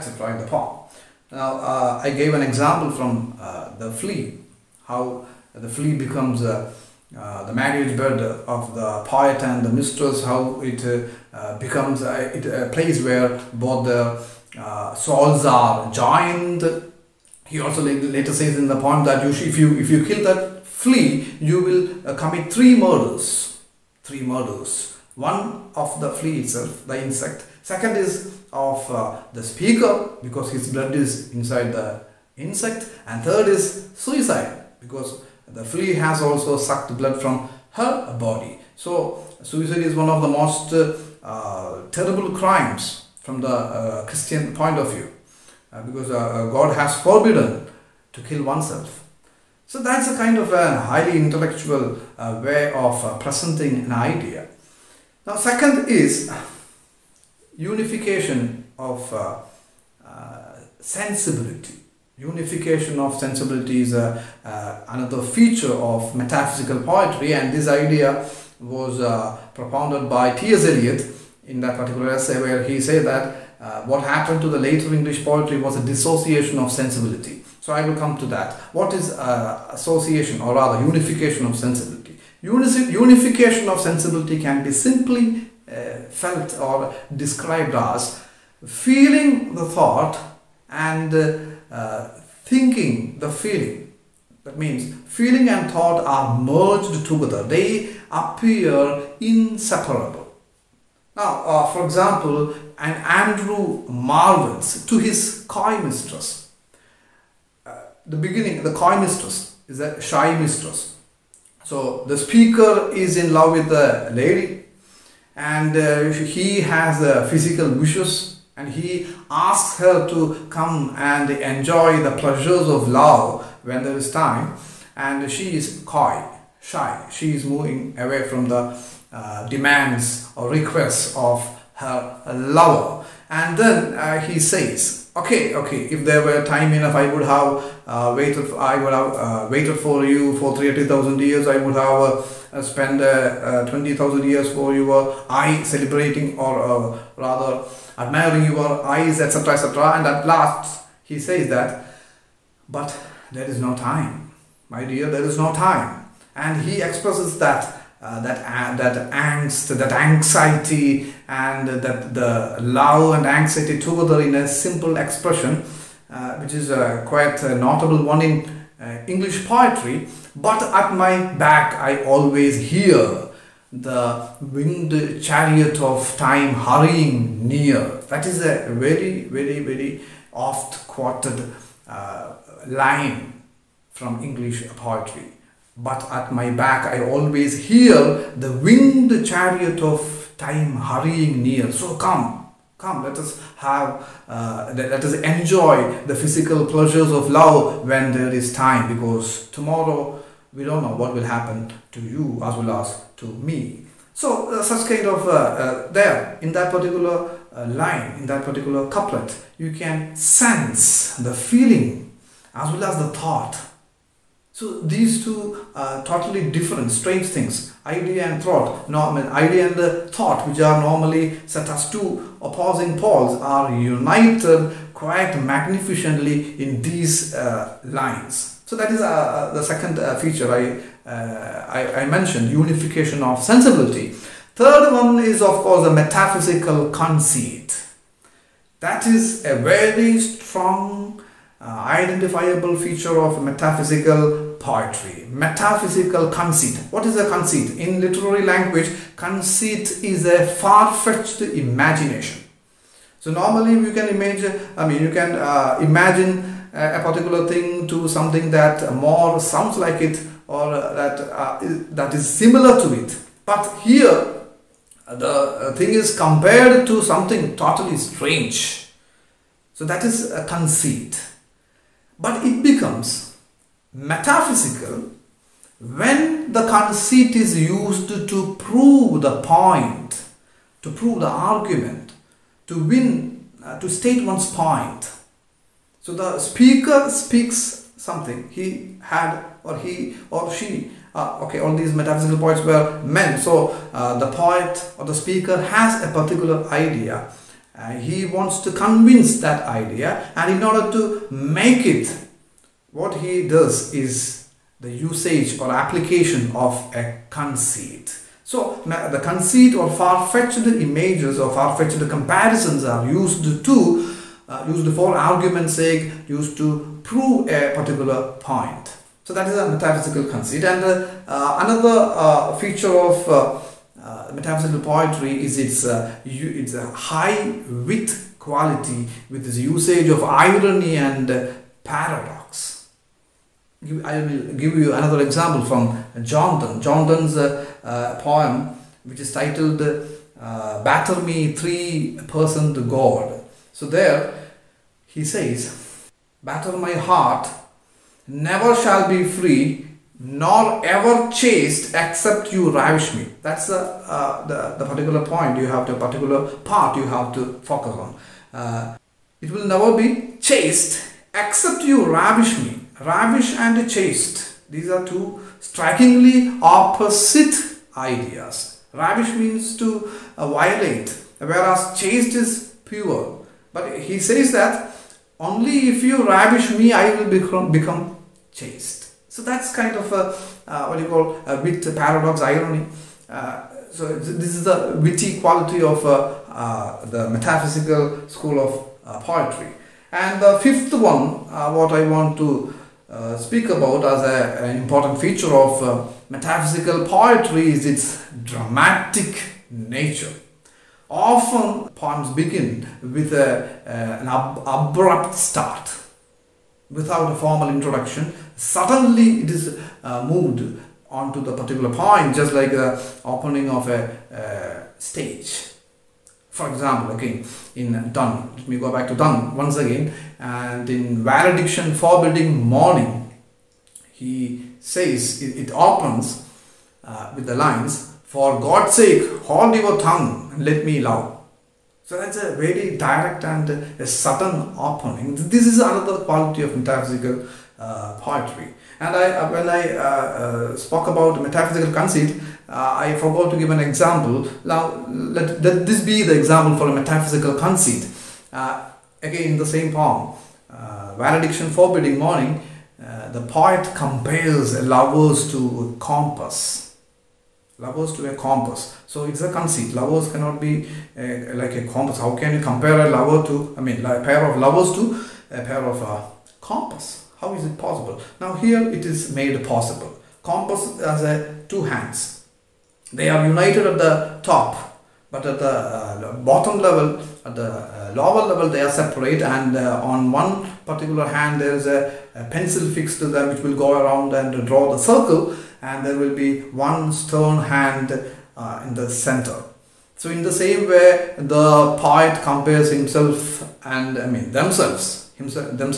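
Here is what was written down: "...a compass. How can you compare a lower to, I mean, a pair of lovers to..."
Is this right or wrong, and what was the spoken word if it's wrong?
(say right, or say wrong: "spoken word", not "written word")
wrong: "lover", not "lower".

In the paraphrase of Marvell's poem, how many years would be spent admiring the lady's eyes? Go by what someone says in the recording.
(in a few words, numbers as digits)
20,000.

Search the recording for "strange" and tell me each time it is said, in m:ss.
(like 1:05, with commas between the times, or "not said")
3:36, 4:27.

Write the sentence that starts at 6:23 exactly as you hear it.
Uh, so this is the witty quality of uh, uh, the metaphysical school of uh, poetry.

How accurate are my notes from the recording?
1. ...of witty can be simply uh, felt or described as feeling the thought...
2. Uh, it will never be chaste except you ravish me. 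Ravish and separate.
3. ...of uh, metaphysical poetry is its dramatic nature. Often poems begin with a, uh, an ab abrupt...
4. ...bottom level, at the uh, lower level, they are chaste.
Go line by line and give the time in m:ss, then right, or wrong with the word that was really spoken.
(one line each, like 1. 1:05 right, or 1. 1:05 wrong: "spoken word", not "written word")
1. 1:23 wrong: "sensibility", not "witty"
2. 5:58 wrong: "chaste", not "separate"
3. 6:35 right
4. 7:56 wrong: "separate", not "chaste".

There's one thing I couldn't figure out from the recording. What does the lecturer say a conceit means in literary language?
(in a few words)
far-fetched imagination.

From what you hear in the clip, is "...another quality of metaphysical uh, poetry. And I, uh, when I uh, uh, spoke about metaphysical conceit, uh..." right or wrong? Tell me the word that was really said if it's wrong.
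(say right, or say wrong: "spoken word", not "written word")
right.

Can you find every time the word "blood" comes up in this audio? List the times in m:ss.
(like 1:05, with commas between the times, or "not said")
0:30, 0:36.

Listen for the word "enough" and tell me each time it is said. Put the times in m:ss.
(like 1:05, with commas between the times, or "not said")
2:16.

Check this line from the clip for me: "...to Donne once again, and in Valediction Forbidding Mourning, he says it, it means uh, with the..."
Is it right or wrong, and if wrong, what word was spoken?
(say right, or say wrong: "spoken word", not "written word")
wrong: "opens", not "means".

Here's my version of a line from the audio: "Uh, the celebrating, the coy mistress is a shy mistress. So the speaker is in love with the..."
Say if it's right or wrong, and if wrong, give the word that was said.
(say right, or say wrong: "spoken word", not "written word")
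wrong: "beginning", not "celebrating".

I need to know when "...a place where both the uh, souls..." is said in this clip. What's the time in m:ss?
0:12.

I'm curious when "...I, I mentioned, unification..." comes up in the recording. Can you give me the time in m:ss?
3:51.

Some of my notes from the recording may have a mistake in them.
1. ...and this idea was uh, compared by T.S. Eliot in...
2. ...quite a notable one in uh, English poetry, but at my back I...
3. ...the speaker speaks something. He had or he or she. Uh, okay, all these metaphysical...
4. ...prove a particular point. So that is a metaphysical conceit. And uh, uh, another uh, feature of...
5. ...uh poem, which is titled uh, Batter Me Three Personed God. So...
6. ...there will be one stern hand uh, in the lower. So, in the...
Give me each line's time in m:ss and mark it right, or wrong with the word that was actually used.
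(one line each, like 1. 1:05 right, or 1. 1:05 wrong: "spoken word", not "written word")
1. 1:07 wrong: "propounded", not "compared"
2. 2:47 right
3. 4:46 right
4. 5:17 right
5. 5:37 right
6. 8:06 wrong: "center", not "lower".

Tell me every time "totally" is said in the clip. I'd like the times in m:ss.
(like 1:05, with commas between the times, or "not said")
3:36, 4:27.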